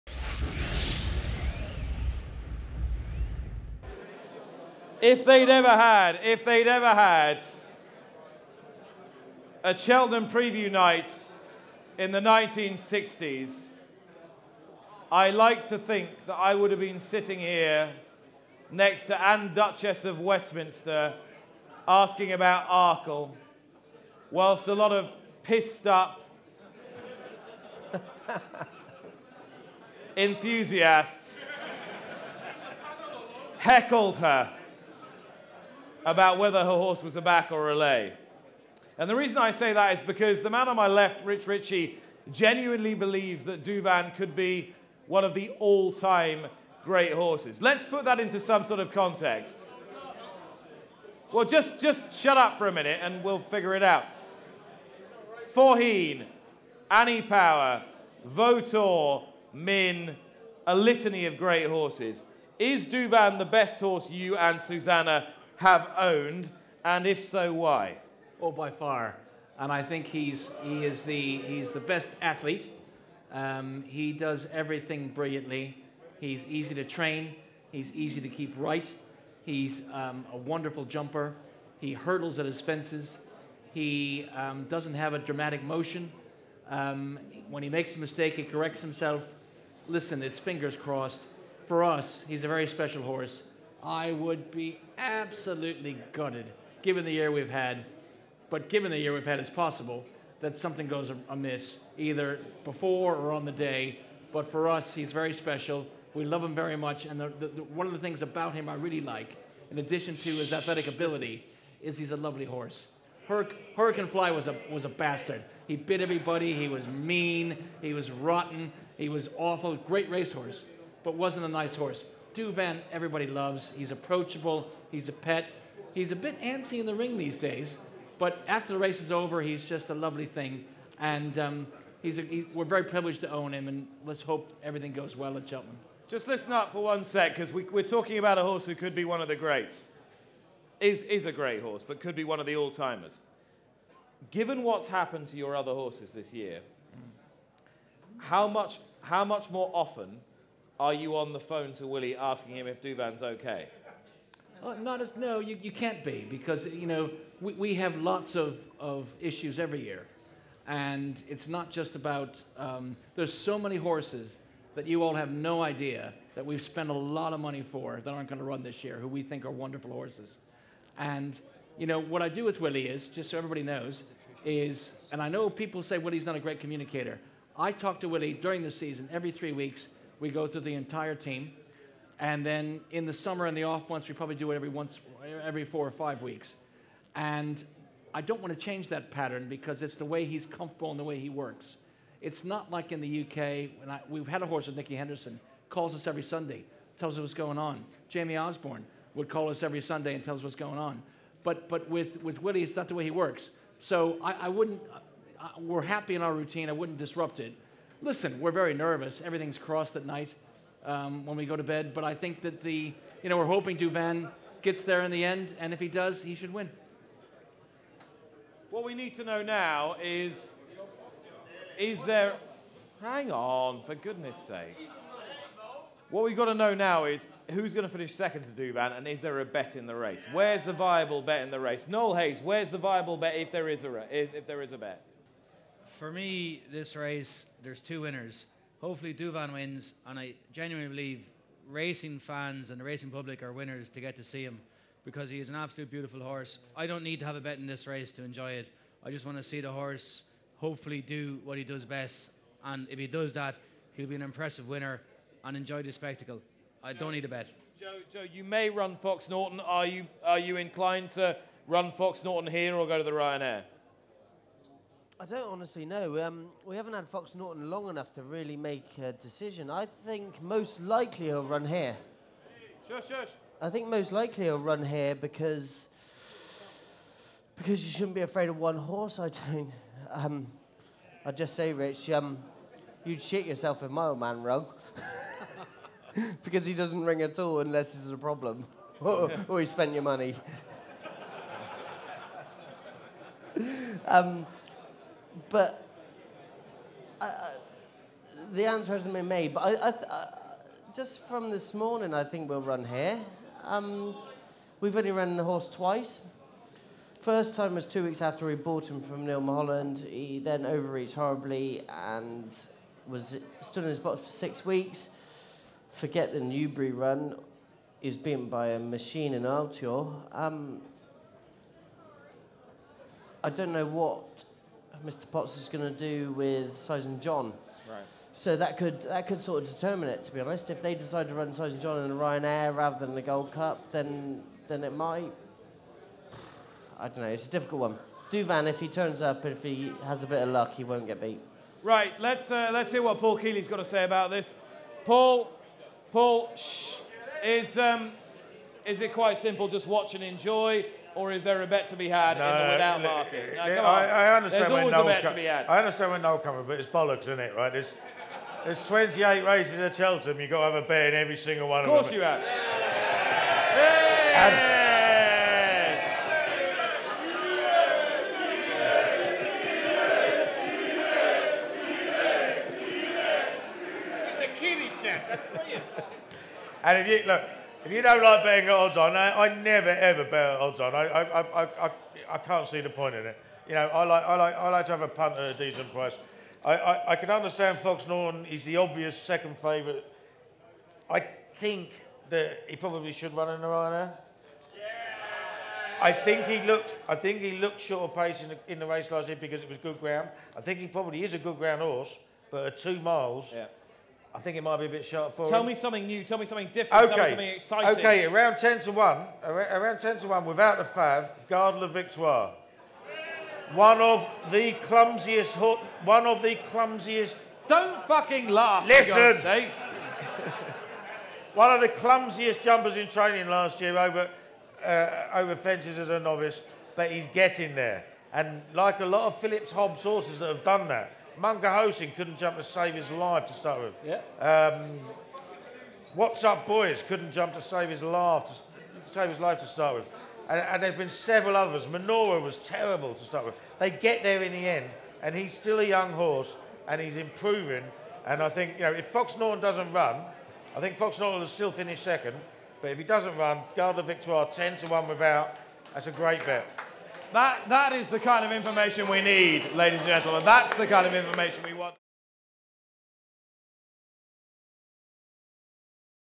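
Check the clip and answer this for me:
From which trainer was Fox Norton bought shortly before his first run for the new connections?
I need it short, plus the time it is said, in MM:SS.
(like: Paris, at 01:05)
Neil Mulholland, at 05:09.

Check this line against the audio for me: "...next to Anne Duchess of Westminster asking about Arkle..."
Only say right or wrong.
right.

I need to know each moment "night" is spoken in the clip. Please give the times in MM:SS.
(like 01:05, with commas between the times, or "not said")
00:10, 03:30.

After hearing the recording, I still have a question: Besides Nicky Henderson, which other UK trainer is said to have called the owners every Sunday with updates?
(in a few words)
Jamie Osborne.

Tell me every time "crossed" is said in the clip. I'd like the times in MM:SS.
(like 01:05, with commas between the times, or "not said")
01:30, 03:29.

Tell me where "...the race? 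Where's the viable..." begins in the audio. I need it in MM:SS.
03:49.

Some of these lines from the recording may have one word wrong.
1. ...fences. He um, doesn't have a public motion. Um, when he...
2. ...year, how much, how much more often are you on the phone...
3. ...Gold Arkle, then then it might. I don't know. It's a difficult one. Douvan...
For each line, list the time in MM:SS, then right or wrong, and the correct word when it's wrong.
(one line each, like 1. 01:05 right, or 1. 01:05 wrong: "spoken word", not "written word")
1. 01:22 wrong: "dramatic", not "public"
2. 02:26 right
3. 05:33 wrong: "Cup", not "Arkle".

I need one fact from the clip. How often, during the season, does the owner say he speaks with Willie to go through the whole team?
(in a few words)
every 3 weeks.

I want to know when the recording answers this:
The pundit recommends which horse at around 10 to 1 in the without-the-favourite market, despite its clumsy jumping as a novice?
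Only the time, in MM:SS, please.
06:51.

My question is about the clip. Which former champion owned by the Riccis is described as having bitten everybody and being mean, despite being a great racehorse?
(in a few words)
Hurricane Fly.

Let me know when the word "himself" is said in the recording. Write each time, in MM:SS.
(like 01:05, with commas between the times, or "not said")
01:28.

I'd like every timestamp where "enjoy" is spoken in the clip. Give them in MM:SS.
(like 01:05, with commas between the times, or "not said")
04:08, 04:15, 05:50.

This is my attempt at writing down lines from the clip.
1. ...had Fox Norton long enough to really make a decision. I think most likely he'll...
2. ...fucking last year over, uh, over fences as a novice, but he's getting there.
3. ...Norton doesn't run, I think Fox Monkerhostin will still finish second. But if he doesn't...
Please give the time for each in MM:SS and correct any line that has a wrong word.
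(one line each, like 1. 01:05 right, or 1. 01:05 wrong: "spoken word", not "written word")
1. 04:26 right
2. 07:03 wrong: "training", not "fucking"
3. 07:29 wrong: "Norton", not "Monkerhostin".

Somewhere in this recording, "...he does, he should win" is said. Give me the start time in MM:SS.
03:35.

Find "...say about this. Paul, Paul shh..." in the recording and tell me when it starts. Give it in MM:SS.
05:43.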